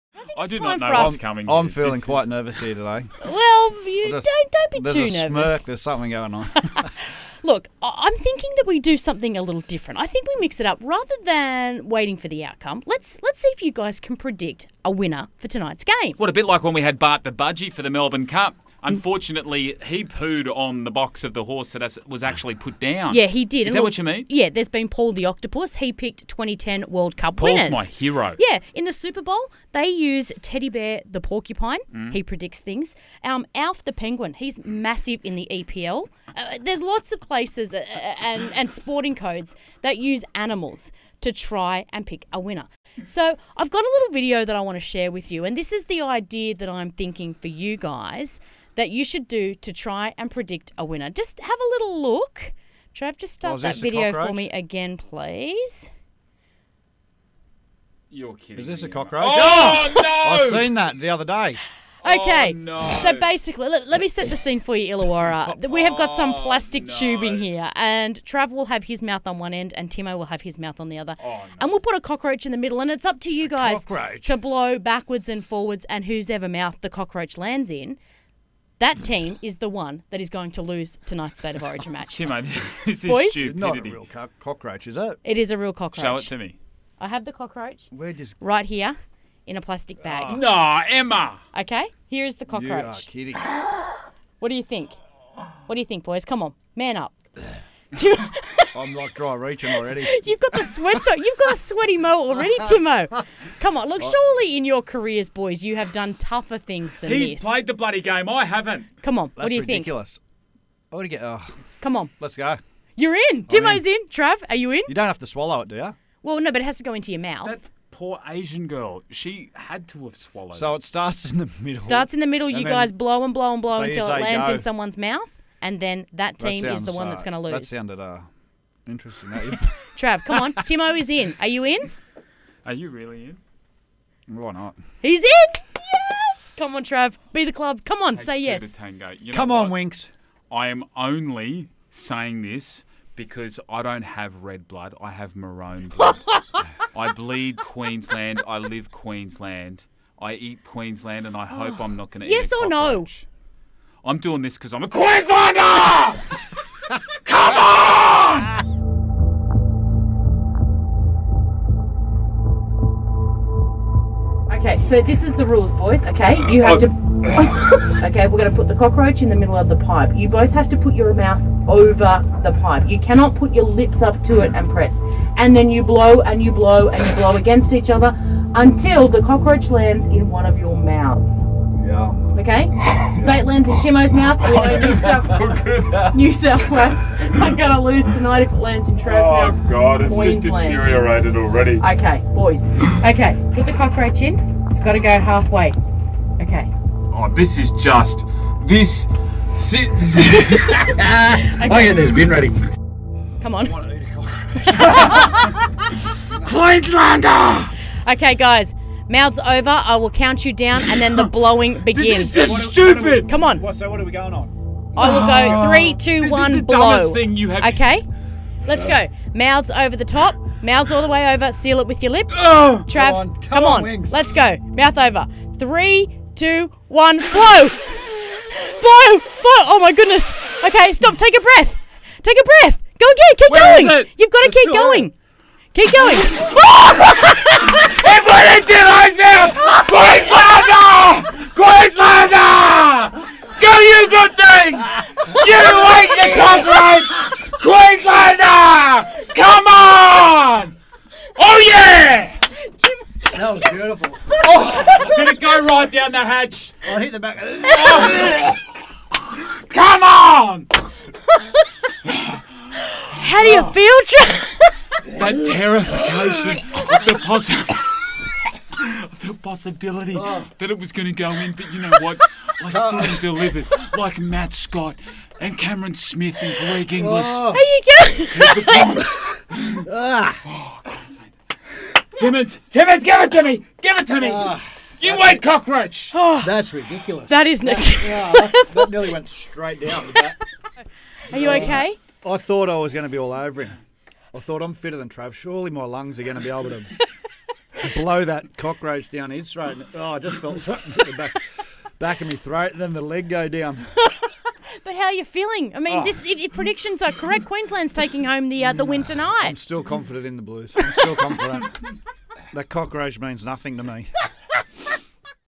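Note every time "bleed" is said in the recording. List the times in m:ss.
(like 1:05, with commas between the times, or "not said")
2:27.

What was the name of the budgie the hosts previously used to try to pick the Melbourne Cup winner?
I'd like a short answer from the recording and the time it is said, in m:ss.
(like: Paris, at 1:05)
Bart, at 0:16.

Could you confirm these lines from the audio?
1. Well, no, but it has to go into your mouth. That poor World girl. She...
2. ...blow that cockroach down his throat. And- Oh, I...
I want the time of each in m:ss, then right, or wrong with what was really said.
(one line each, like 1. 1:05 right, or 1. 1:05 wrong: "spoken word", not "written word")
1. 1:56 wrong: "Asian", not "World"
2. 4:57 right.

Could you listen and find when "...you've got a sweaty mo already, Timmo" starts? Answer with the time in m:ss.
1:41.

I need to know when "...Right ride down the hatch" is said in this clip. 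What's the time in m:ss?
4:15.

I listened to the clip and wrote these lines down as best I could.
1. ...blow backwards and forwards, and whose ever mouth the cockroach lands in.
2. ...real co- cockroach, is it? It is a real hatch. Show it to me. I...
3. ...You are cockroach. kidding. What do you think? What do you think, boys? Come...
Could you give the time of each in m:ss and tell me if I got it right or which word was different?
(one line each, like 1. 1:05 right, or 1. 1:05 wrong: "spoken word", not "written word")
1. 1:14 right
2. 1:23 wrong: "cockroach", not "hatch"
3. 1:32 right.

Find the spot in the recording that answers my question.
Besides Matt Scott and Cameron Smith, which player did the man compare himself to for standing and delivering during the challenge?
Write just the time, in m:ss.
4:36.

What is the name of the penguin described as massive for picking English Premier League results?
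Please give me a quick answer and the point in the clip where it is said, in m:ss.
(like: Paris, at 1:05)
Alf, at 0:33.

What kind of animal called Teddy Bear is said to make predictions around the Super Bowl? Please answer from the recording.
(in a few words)
Porcupine.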